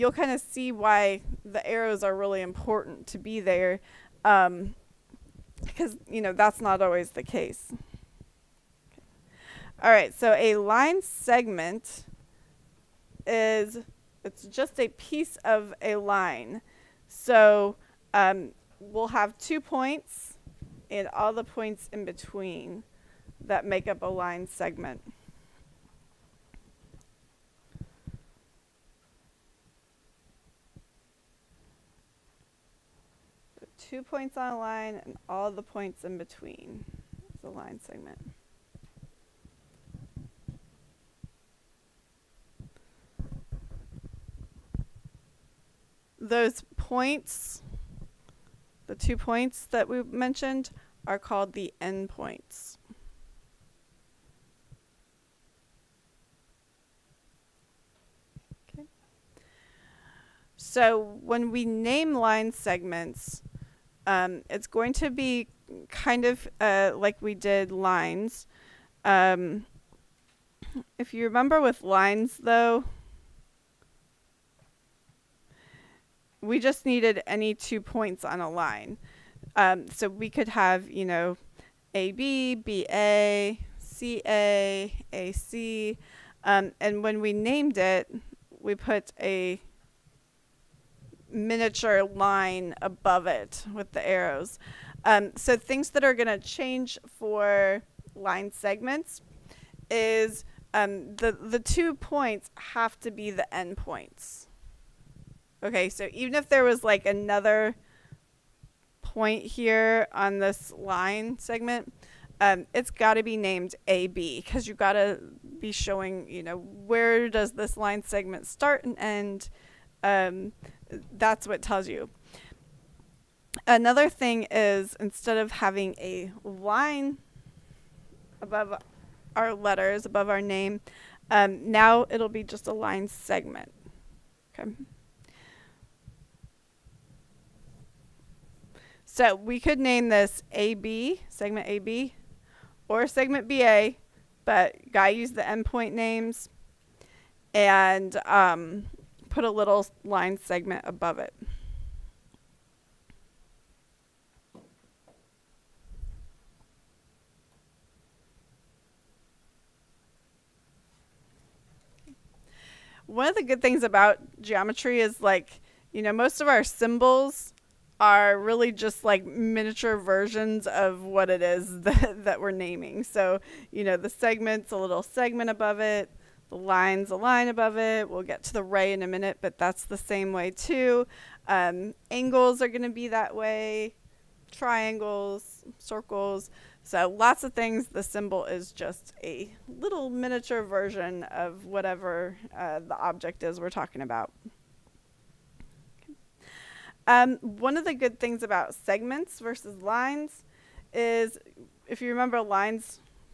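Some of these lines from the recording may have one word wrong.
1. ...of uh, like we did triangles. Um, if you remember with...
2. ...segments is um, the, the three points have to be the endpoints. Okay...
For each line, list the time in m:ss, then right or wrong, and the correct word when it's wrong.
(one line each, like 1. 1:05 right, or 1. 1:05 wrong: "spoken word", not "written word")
1. 1:06 wrong: "lines", not "triangles"
2. 1:38 wrong: "two", not "three".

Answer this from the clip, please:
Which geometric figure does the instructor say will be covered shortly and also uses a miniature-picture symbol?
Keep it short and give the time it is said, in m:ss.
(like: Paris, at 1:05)
ray, at 2:58.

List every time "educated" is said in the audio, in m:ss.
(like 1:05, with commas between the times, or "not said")
not said.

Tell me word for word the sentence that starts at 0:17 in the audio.
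So um, we'll have two points and all the points in between that make up a line segment.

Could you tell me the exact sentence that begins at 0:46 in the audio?
those points, the two points that we mentioned, are called the endpoints.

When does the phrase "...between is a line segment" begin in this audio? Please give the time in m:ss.
0:36.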